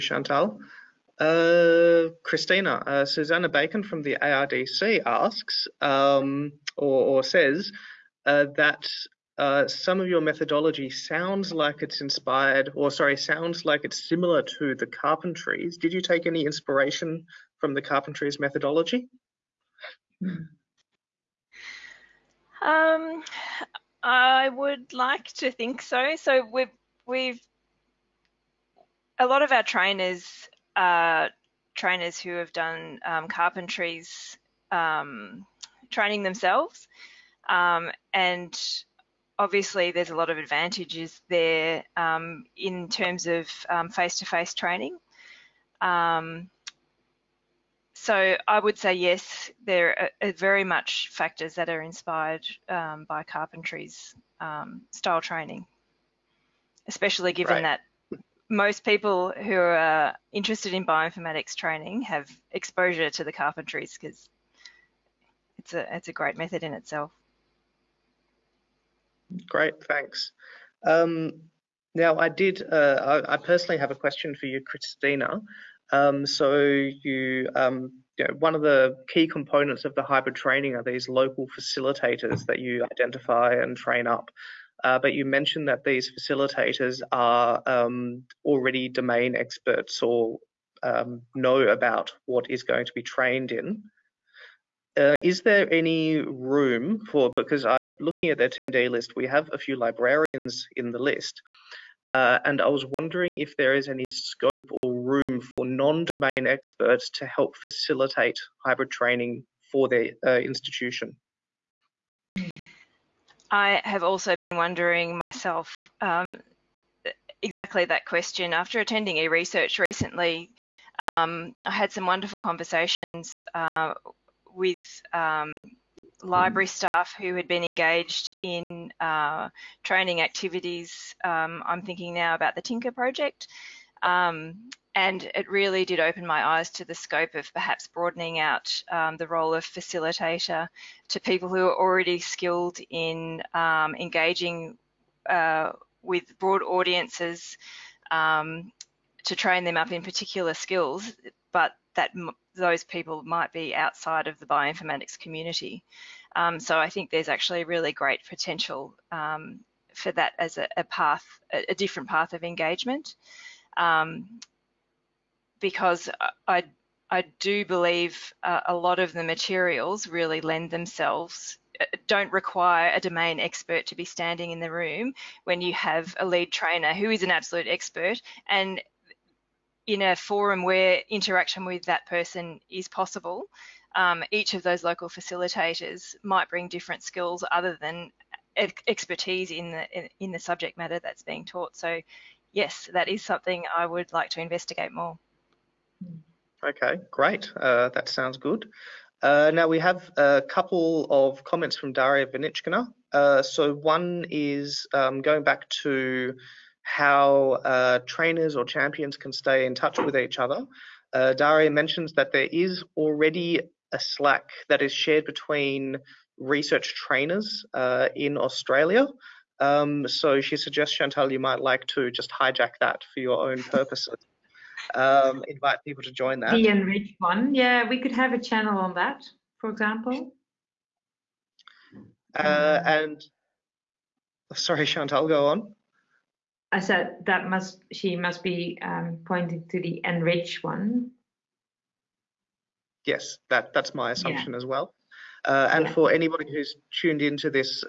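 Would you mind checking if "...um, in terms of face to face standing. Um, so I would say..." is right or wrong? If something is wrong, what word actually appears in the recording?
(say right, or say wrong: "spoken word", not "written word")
wrong: "training", not "standing".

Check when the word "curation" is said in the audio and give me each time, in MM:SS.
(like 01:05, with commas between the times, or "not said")
not said.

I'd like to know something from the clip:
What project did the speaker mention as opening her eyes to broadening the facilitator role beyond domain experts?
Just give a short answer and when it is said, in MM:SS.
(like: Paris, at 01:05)
Tinker project, at 02:12.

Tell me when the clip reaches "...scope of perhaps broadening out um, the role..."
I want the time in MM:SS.
02:16.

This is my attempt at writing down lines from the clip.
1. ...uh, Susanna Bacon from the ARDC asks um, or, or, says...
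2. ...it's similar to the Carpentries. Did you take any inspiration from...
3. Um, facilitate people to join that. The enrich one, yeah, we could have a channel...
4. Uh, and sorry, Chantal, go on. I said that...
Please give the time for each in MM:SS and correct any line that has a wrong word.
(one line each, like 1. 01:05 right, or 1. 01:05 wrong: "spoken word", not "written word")
1. 00:02 right
2. 00:13 right
3. 03:44 wrong: "invite", not "facilitate"
4. 03:52 right.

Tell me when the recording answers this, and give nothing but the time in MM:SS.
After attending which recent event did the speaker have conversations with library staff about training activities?
01:59.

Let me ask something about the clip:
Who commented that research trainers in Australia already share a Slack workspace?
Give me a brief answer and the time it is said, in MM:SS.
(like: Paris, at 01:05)
Daria Vinichkina, at 03:21.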